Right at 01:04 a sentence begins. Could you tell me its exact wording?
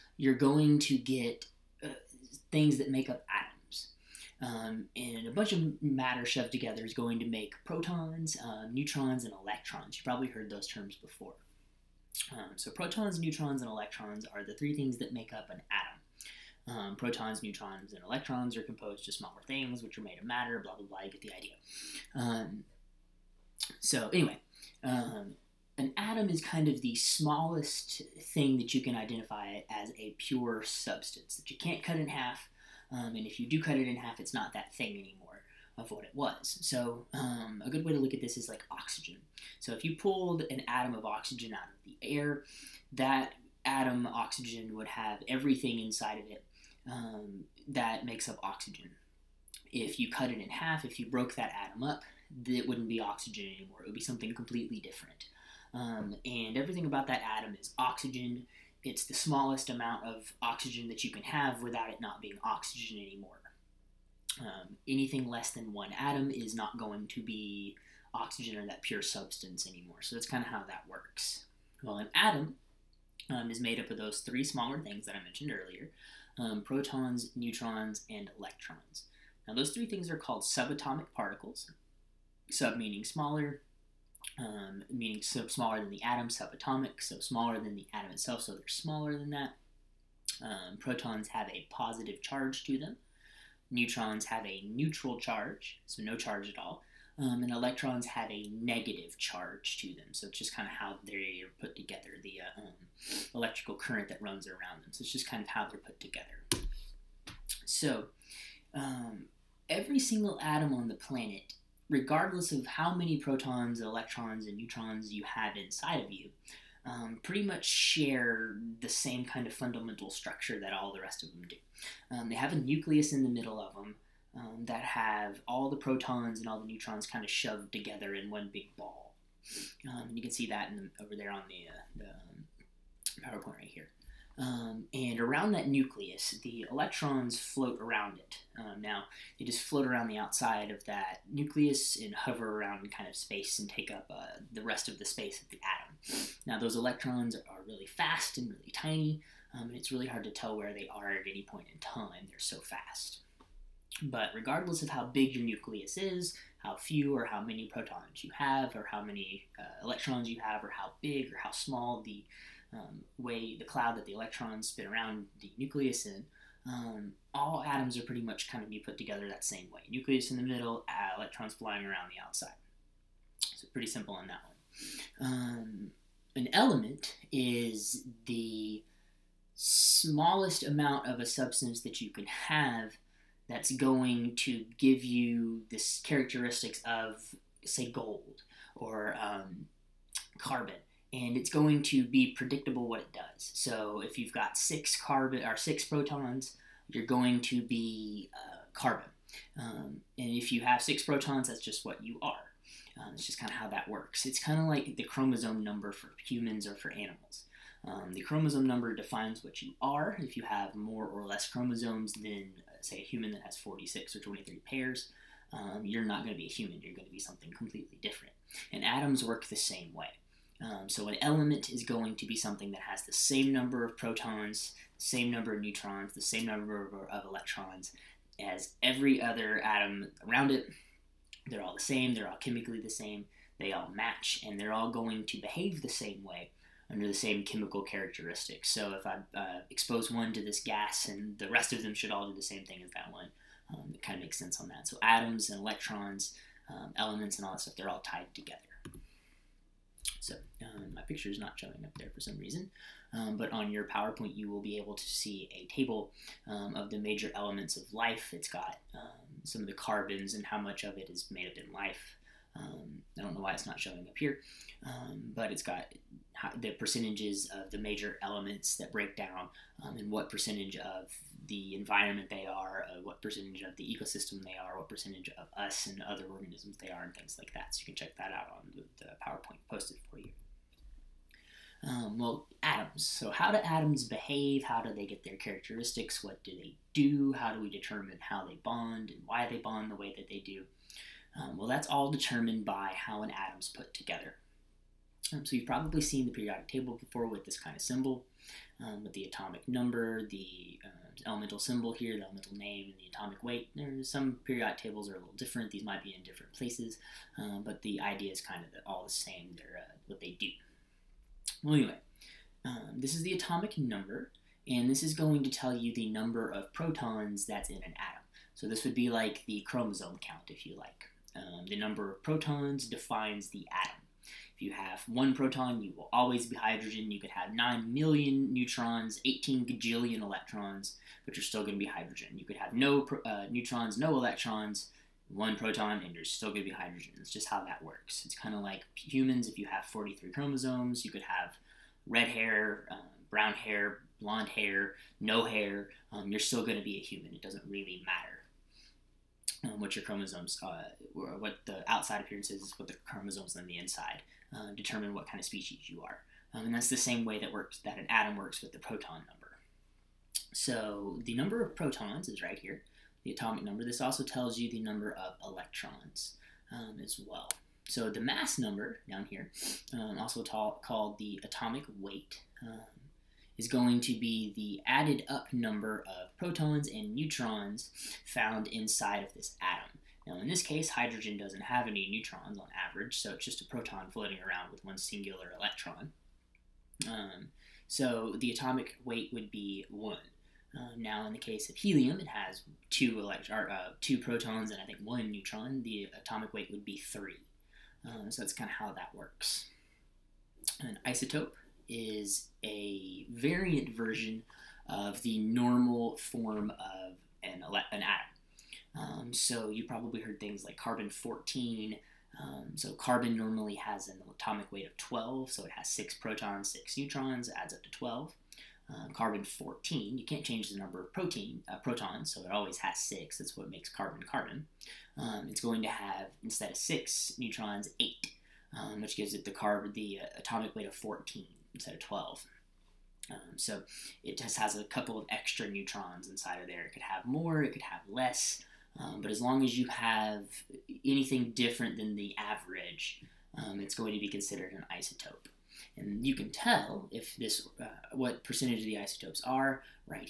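Um, anything less than one atom is not going to be oxygen or that pure substance anymore.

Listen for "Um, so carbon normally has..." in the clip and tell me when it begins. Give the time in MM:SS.
06:52.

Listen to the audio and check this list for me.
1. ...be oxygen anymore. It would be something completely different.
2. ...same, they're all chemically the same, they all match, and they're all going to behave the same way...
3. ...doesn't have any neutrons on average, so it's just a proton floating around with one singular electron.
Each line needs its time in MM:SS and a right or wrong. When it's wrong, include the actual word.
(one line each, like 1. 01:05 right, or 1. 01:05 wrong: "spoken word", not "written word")
1. 00:52 right
2. 03:51 right
3. 06:21 right.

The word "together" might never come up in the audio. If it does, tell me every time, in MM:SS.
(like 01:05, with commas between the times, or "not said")
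00:06, 01:41, 01:46, 02:07, 02:48, 04:08, 04:53.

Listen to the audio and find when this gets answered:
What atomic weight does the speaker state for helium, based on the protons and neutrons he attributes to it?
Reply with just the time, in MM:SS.
06:36.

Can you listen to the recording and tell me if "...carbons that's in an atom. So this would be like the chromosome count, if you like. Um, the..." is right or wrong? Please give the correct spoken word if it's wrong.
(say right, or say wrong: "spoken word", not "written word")
wrong: "protons", not "carbons".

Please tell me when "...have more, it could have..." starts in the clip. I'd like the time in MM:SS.
07:17.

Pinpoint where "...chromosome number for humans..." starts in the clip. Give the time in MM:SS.
03:25.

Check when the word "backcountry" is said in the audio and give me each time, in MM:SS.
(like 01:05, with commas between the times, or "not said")
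not said.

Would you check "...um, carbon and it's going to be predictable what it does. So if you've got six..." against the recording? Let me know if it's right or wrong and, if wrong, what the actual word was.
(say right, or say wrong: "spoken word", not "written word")
right.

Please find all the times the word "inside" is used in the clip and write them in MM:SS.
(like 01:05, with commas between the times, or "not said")
00:45, 01:55, 05:53, 06:18, 07:16.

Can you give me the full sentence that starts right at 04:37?
So you can check that out on the, the PowerPoint posted for you.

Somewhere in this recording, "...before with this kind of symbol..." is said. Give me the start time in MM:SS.
04:57.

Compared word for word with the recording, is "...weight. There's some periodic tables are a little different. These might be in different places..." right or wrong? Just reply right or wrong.
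right.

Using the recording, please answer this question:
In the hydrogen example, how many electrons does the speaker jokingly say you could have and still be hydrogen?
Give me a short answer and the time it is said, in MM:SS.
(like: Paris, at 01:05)
18 gajillion, at 05:29.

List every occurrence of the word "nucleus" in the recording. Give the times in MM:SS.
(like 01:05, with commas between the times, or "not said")
02:02, 02:15, 02:21, 02:35, 02:45, 02:49.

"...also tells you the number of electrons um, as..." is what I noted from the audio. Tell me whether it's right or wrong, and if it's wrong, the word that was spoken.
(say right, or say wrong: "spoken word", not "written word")
right.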